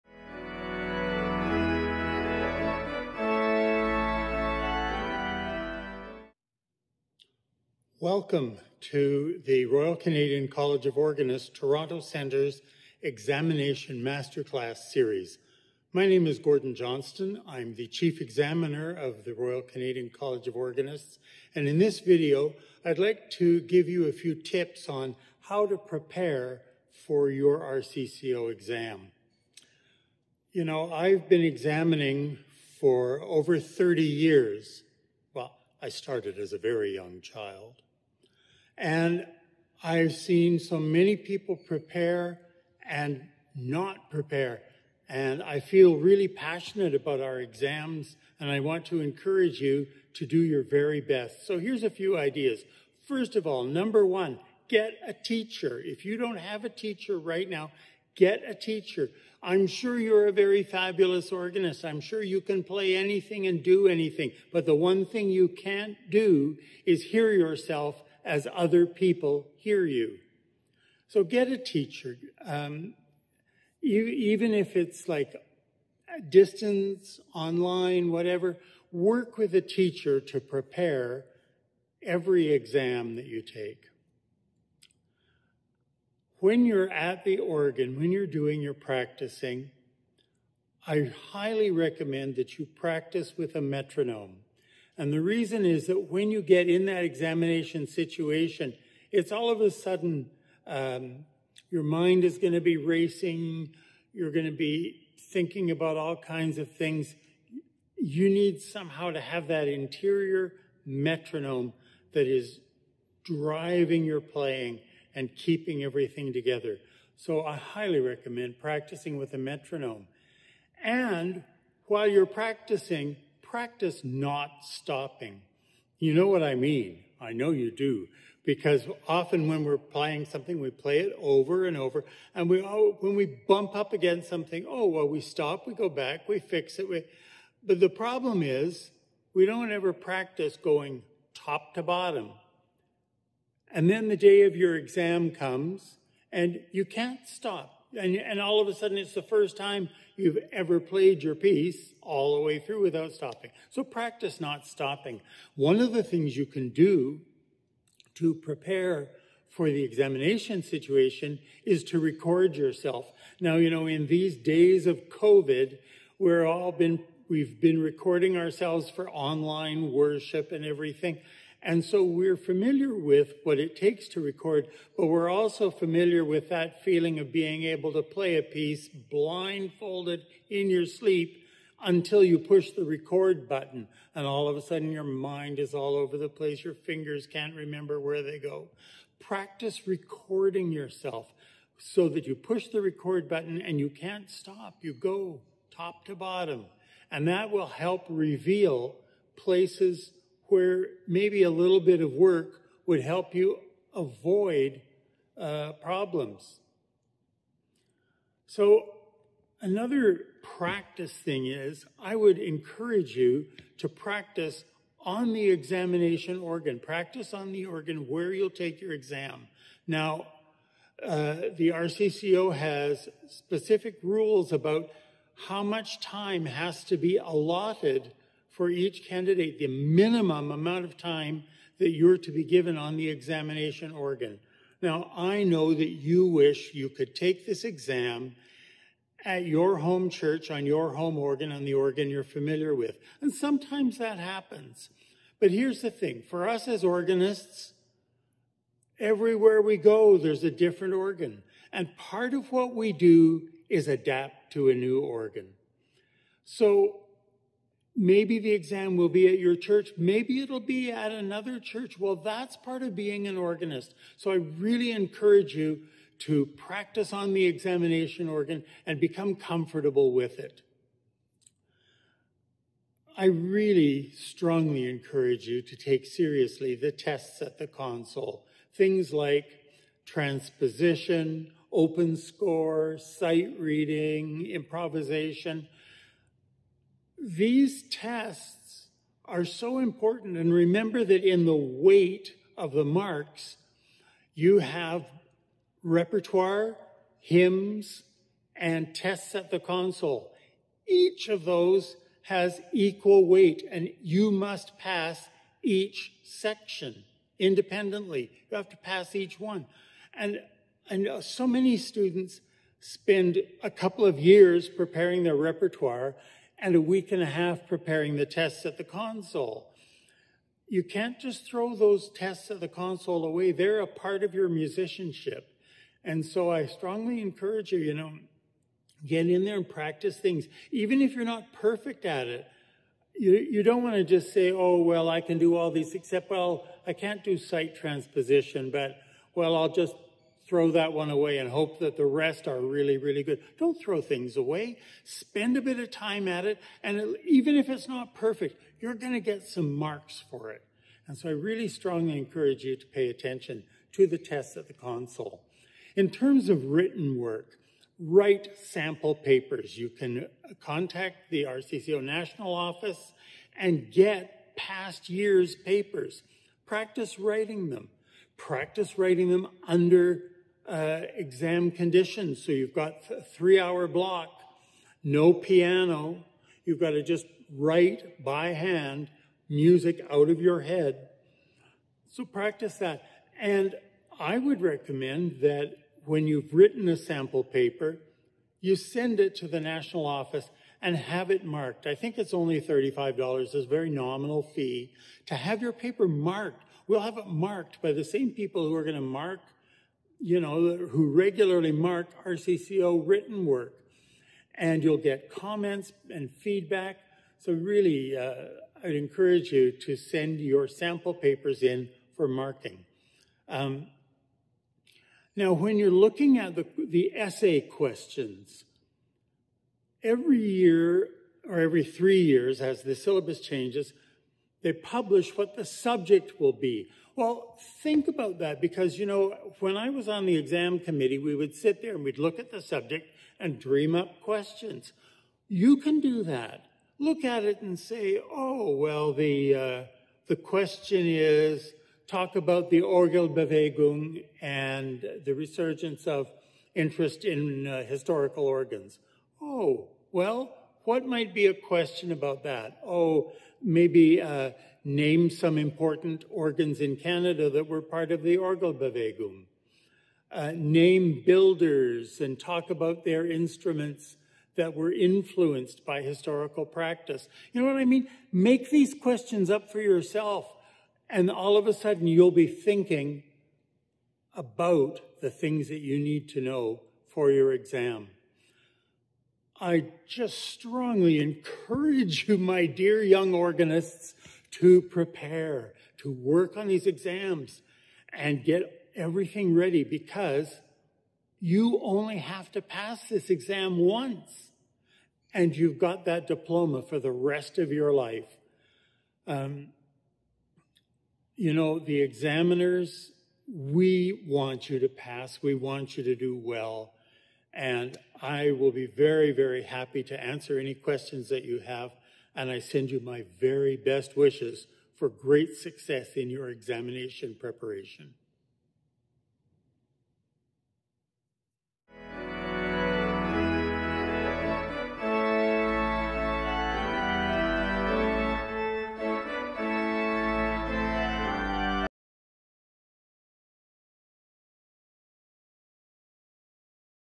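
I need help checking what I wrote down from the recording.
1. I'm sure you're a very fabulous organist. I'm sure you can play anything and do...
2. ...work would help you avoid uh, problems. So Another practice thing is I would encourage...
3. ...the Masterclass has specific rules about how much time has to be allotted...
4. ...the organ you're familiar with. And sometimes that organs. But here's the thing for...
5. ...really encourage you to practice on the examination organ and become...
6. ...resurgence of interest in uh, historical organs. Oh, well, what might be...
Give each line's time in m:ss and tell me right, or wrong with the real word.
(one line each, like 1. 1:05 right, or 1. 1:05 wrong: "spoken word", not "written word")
1. 0:59 right
2. 3:22 right
3. 3:41 wrong: "RCCO", not "Masterclass"
4. 4:01 wrong: "happens", not "organs"
5. 4:24 right
6. 7:25 right.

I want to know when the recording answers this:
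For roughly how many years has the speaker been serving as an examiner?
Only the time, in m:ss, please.
0:33.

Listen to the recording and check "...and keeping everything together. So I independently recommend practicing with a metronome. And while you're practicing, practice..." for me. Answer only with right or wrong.
wrong.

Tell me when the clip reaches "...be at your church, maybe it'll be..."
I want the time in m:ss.
4:19.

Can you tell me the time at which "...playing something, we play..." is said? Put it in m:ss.
2:09.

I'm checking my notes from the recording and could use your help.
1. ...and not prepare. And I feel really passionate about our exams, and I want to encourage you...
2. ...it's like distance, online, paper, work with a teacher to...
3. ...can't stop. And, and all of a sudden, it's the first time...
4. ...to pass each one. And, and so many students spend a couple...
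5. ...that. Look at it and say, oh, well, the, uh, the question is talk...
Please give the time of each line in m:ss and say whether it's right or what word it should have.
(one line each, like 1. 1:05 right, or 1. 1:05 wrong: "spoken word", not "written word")
1. 0:42 right
2. 1:14 wrong: "whatever", not "paper"
3. 2:26 right
4. 5:08 right
5. 7:16 right.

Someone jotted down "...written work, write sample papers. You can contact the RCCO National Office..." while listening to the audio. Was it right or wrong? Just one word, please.
right.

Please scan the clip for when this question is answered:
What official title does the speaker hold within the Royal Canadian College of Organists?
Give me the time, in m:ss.
0:17.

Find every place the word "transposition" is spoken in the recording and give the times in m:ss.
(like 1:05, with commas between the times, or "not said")
4:40, 5:37.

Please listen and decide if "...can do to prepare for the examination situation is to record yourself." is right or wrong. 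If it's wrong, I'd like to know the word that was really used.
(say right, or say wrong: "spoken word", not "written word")
right.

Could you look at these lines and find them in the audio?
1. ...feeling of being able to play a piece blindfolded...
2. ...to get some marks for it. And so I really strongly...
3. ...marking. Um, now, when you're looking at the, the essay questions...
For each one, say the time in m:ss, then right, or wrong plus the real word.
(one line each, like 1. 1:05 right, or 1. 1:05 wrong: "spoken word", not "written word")
1. 2:56 right
2. 5:49 right
3. 6:52 right.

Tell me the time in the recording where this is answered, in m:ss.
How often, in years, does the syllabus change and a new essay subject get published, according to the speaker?
7:01.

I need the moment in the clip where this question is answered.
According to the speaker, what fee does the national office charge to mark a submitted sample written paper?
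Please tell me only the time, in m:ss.
6:32.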